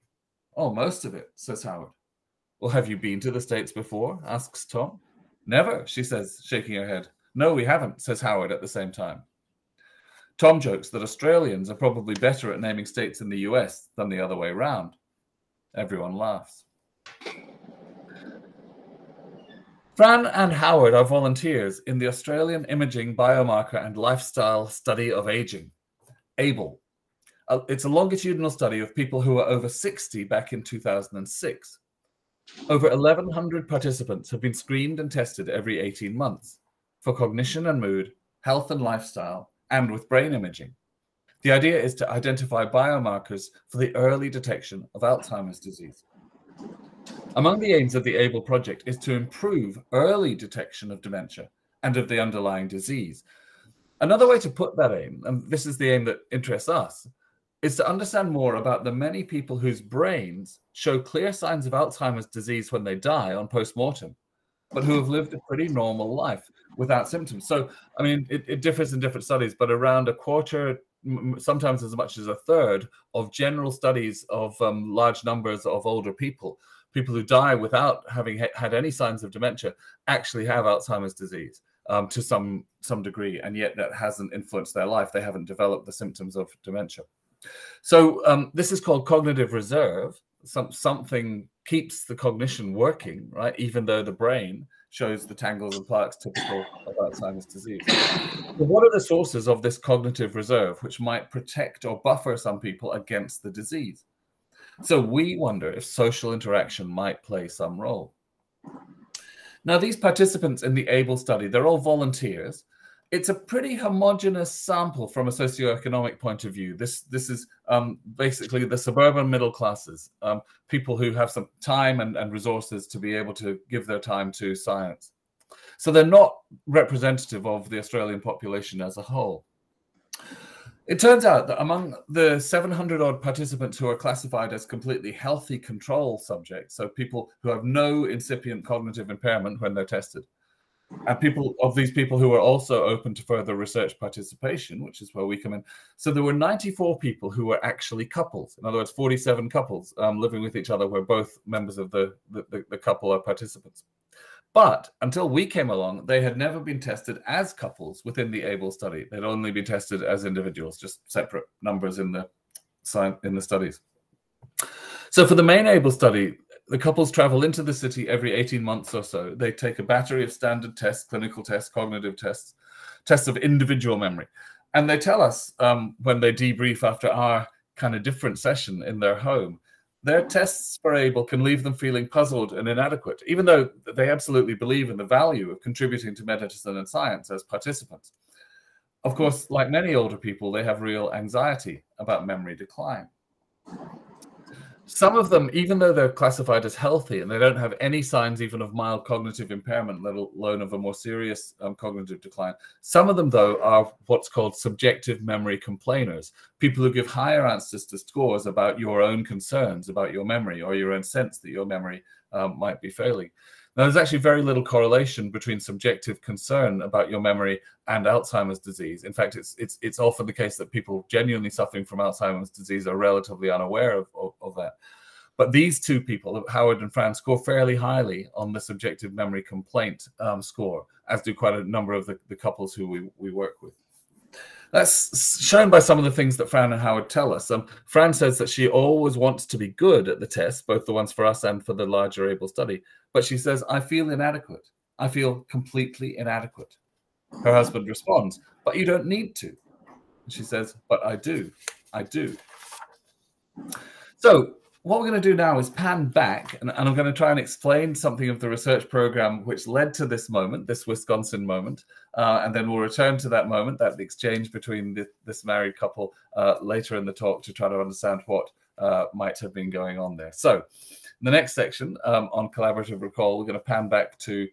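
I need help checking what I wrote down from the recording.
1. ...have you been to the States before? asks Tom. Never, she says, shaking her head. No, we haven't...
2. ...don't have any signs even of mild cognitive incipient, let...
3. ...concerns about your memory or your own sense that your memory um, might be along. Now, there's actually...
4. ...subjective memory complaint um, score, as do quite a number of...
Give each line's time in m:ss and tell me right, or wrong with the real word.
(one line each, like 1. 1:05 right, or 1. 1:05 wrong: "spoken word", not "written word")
1. 0:02 right
2. 3:17 wrong: "impairment", not "incipient"
3. 3:29 wrong: "failing", not "along"
4. 3:48 right.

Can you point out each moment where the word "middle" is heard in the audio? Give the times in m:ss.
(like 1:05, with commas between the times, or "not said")
1:59.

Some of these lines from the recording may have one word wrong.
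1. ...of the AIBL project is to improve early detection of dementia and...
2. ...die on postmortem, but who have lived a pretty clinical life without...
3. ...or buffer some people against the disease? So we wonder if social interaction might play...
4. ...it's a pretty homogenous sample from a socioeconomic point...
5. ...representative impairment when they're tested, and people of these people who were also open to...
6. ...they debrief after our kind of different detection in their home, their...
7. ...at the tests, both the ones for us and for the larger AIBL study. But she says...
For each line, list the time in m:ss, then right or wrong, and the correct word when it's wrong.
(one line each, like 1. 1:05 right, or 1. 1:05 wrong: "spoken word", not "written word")
1. 0:47 right
2. 1:02 wrong: "normal", not "clinical"
3. 1:41 right
4. 1:53 right
5. 2:18 wrong: "cognitive", not "representative"
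6. 2:56 wrong: "session", not "detection"
7. 4:00 right.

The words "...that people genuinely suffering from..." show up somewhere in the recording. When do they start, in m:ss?
3:40.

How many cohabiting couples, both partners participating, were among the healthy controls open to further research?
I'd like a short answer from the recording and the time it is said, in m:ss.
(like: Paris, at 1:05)
47, at 2:28.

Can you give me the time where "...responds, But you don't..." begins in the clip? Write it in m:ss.
4:07.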